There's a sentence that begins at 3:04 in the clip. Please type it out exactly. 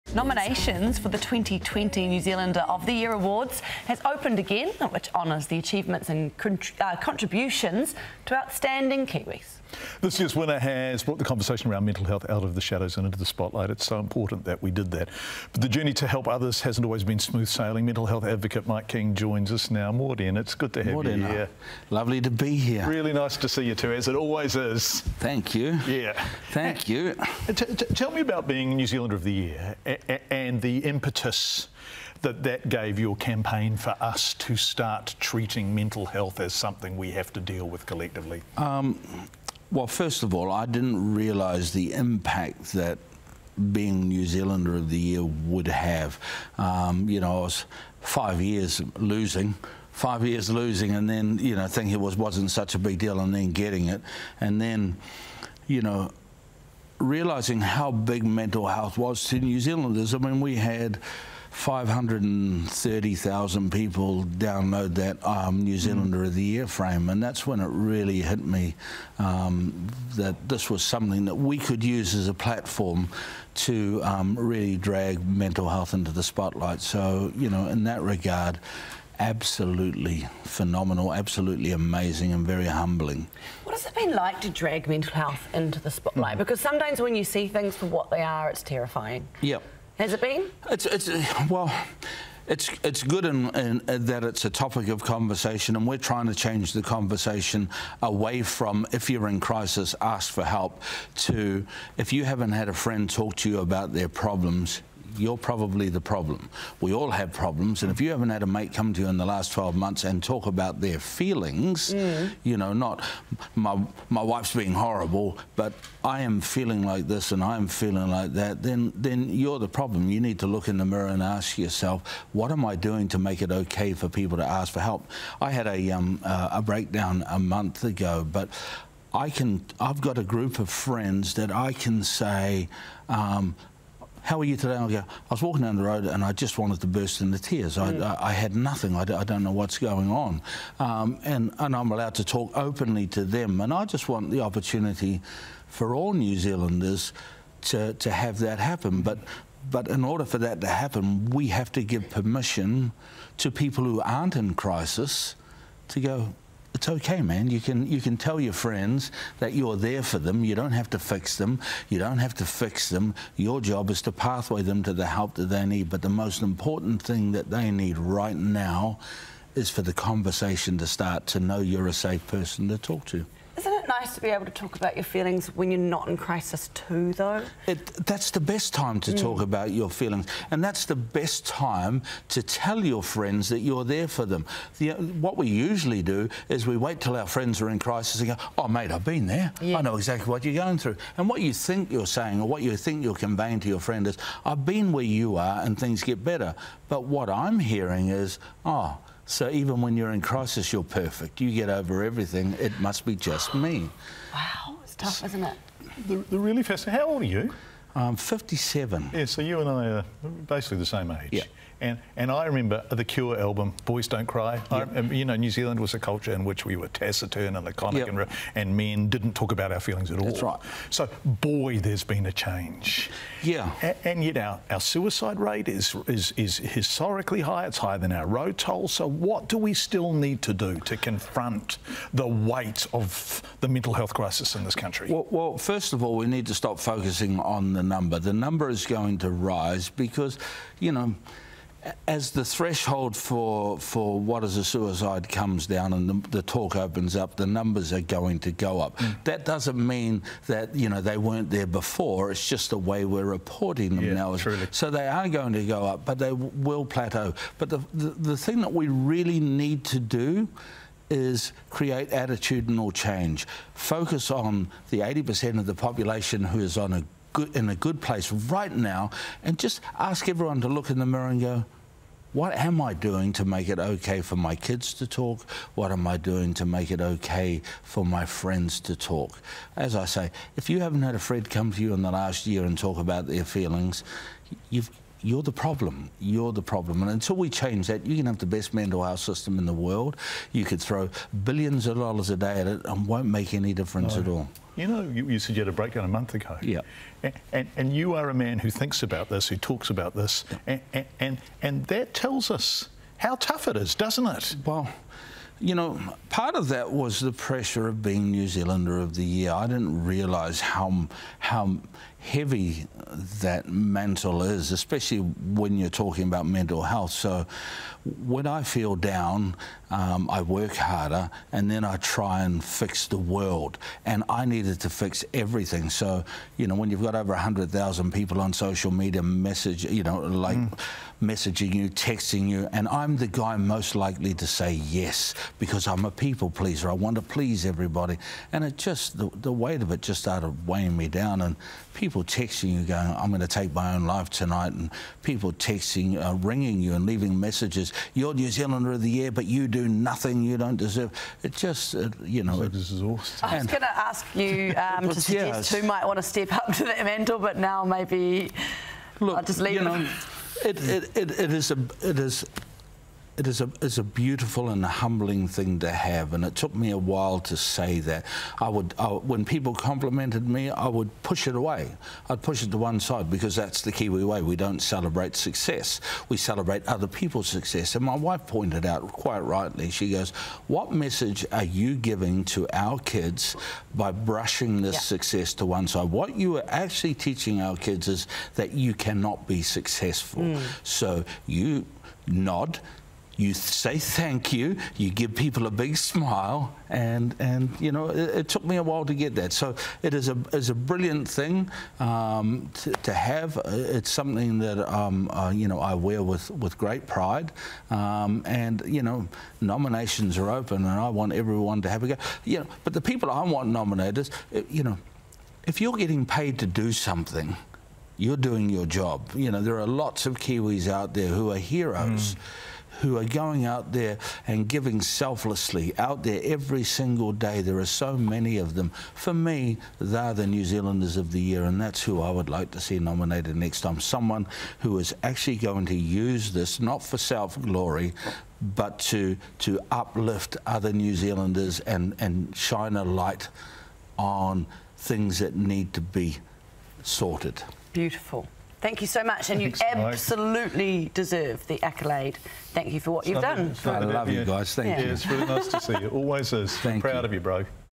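The, what we usually do is we wait till our friends are in crisis and go, "Oh, mate, I've been there.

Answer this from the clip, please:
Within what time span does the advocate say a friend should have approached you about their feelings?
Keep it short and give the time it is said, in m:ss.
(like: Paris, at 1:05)
12 months, at 1:49.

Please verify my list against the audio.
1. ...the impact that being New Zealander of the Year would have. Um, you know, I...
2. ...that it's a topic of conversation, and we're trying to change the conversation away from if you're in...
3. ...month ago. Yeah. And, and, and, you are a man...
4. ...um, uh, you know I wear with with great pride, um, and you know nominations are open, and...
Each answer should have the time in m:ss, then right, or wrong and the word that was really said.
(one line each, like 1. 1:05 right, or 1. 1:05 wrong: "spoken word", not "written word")
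1. 0:41 right
2. 1:33 right
3. 4:56 right
4. 6:44 right.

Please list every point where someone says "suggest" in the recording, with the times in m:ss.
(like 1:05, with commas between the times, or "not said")
5:55.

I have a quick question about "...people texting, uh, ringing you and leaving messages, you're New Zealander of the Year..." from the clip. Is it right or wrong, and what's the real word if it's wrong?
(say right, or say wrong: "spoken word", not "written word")
right.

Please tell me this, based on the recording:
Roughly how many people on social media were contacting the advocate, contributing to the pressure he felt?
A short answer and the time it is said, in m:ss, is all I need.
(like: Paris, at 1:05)
over 100,000, at 5:27.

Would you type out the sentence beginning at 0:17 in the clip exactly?
Mental health advocate Mike King joins us now.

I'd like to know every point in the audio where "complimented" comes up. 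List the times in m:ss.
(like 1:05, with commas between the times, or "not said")
6:09.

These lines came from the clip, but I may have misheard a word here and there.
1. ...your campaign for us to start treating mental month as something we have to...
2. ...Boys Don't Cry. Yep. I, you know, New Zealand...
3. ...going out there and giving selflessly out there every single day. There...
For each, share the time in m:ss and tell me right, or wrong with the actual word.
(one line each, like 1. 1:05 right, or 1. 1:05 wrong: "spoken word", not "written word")
1. 0:32 wrong: "health", not "month"
2. 3:33 right
3. 7:03 right.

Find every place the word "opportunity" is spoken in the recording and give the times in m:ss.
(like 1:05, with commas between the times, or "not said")
2:24.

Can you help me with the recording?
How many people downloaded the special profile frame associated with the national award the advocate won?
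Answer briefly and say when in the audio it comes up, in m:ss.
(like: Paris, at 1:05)
530,000, at 1:01.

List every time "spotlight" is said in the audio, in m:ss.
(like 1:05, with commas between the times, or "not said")
0:13, 1:16, 1:25.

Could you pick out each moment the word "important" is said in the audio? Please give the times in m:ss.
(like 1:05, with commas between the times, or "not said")
0:13, 2:46.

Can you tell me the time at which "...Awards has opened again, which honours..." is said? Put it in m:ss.
0:03.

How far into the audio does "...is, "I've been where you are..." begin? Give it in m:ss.
3:14.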